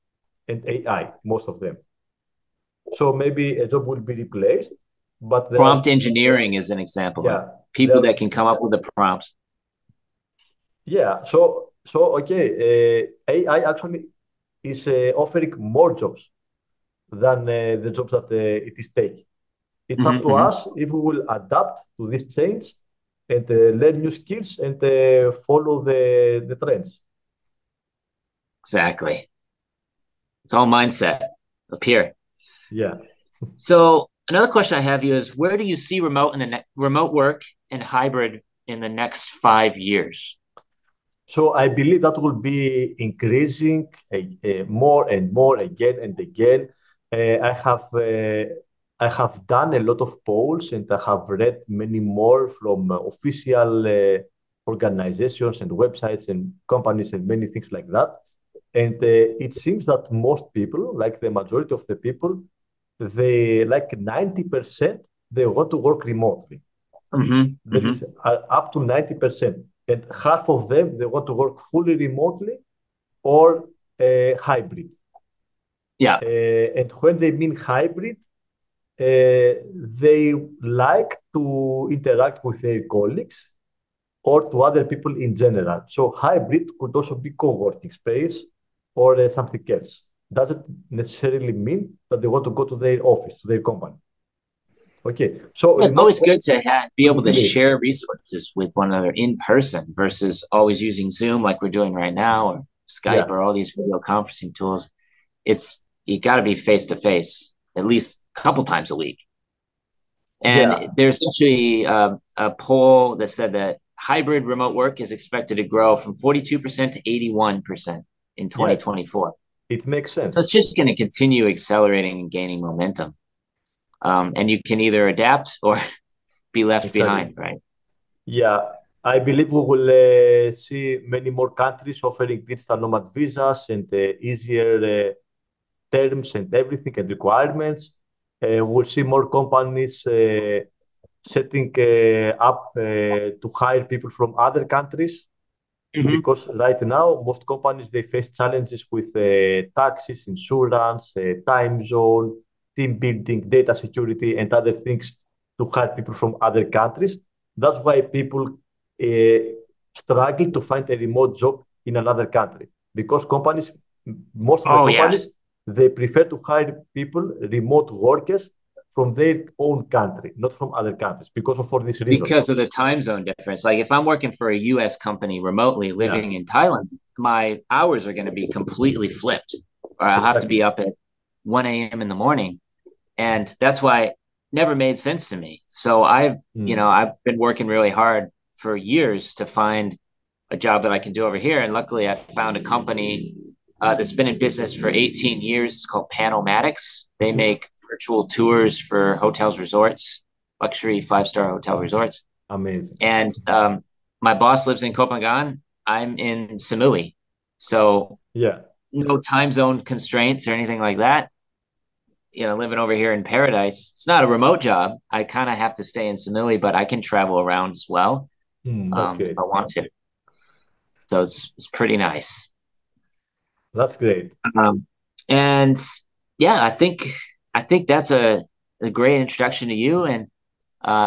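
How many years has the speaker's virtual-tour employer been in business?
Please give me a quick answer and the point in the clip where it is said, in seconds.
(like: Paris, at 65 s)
18, at 194 s.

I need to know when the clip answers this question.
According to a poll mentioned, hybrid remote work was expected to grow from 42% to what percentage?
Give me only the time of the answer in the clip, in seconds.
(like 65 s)
117 s.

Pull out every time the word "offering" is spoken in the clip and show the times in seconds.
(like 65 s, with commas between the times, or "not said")
15 s, 132 s.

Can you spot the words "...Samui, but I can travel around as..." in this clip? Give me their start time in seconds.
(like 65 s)
216 s.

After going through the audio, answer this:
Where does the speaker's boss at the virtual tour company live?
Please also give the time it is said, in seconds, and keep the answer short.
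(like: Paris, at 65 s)
Copenhagen, at 204 s.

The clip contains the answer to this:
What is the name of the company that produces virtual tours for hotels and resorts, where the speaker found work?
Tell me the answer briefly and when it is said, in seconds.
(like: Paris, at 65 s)
Panomatics, at 196 s.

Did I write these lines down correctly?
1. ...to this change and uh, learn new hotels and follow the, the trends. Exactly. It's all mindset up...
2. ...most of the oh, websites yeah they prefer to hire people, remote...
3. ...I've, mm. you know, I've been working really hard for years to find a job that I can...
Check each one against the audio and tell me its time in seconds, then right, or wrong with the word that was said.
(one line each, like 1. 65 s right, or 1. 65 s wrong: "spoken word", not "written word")
1. 21 s wrong: "skills", not "hotels"
2. 164 s wrong: "companies", not "websites"
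3. 186 s right.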